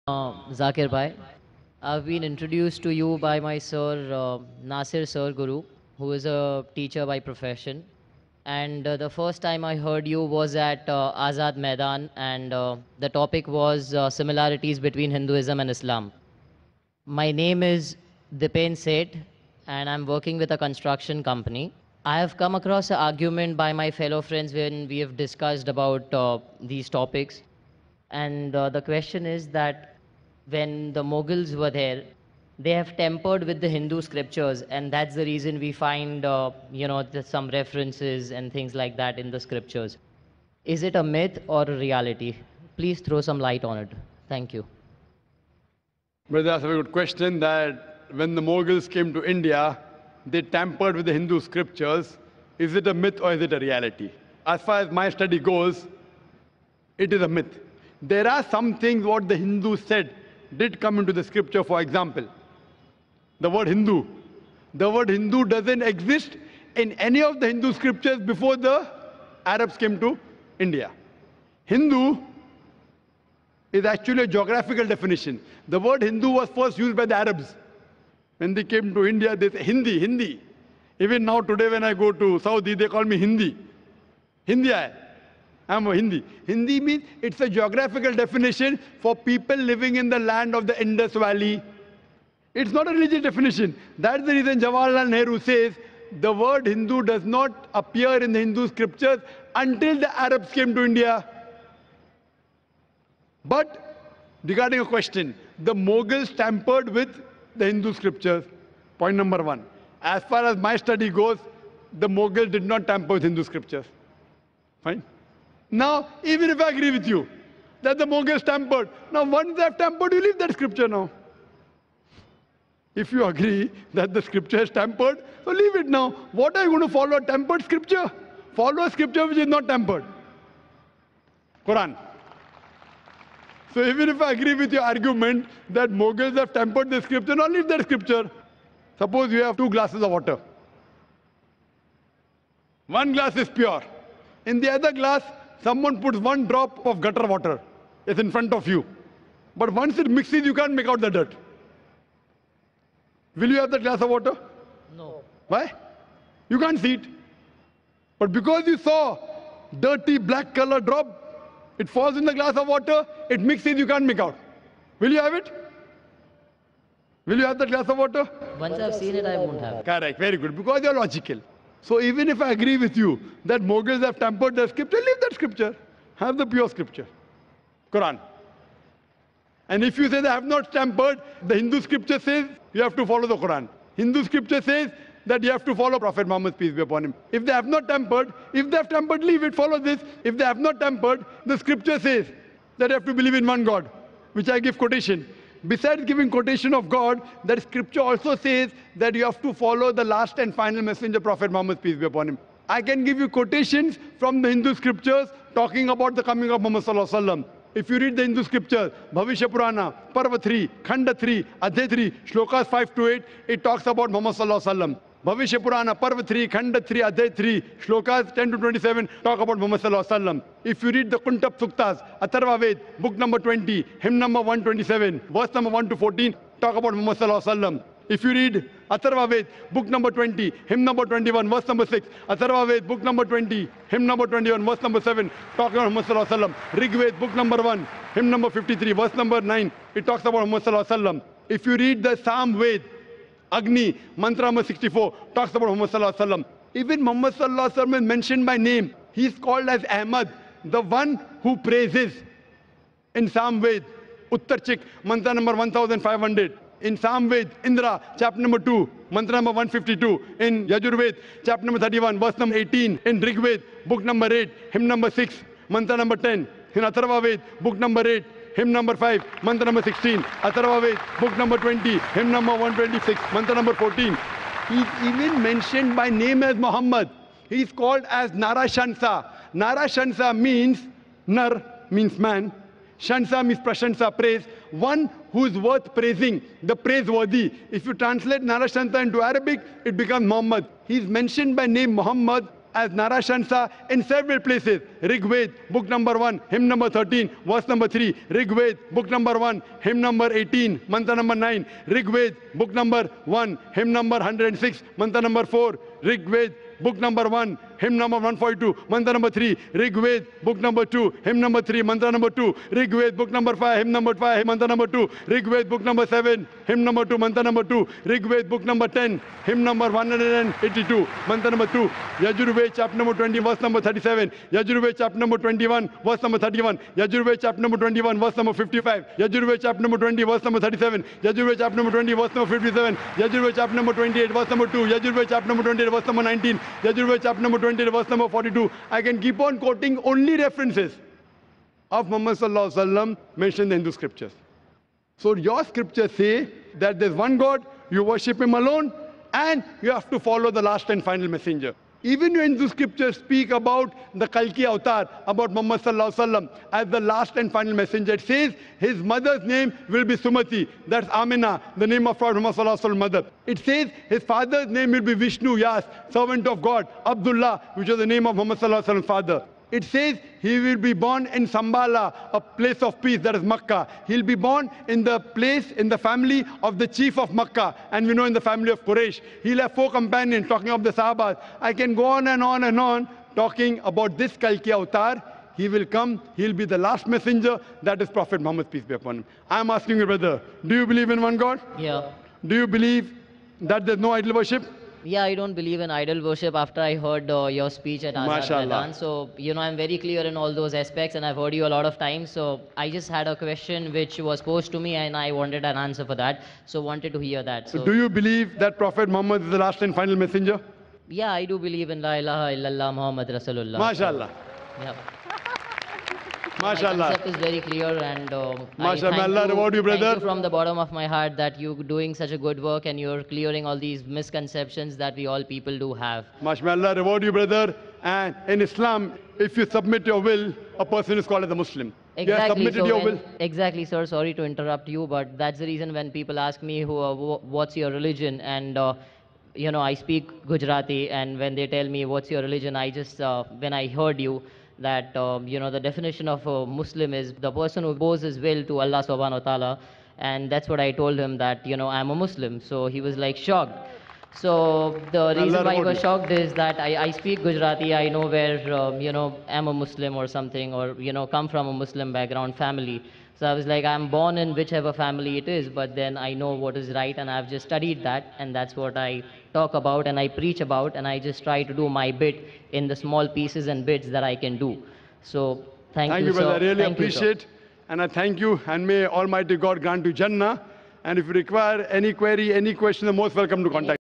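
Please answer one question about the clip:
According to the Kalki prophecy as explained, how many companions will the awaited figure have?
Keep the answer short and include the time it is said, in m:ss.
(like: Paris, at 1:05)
4, at 6:19.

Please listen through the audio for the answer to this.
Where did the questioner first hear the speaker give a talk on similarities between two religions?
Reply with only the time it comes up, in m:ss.
0:11.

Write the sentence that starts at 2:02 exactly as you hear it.
If you agree that the scripture is tempered, so leave it now.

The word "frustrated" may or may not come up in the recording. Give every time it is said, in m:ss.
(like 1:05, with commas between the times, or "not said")
not said.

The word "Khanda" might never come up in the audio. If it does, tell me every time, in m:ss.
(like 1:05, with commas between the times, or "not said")
3:30, 3:36.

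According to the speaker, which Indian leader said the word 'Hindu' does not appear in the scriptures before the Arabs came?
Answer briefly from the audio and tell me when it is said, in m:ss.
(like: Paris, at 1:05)
Jawaharlal Nehru, at 1:34.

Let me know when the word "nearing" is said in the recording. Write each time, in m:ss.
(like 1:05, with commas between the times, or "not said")
not said.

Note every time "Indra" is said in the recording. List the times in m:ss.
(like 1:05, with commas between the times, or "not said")
4:17.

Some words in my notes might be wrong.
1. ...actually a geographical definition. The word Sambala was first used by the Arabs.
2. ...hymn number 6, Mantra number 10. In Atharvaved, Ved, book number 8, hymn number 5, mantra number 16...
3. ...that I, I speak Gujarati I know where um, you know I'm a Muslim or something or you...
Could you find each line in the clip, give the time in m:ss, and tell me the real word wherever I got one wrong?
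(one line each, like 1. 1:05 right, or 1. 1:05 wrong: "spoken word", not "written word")
1. 1:13 wrong: "Hindu", not "Sambala"
2. 4:24 right
3. 7:36 right.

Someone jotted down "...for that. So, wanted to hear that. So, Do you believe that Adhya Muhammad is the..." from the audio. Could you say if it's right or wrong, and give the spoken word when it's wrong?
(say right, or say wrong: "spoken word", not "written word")
wrong: "Prophet", not "Adhya".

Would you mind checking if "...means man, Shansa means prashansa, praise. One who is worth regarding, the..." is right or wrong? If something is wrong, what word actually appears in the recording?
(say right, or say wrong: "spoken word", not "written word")
wrong: "praising", not "regarding".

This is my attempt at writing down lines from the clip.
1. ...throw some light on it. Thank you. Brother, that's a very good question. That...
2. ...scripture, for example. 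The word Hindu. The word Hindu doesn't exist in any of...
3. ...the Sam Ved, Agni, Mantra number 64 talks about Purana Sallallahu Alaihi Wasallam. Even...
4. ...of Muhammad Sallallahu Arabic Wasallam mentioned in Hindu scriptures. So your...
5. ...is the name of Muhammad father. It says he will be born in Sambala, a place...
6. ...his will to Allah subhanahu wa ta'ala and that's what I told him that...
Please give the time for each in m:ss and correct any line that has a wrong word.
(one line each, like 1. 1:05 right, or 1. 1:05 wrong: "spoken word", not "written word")
1. 0:43 right
2. 1:01 right
3. 4:02 wrong: "Muhammad", not "Purana"
4. 5:41 wrong: "Alaihi", not "Arabic"
5. 6:07 right
6. 7:28 right.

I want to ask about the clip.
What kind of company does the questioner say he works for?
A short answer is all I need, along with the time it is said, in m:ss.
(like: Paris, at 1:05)
construction company, at 0:20.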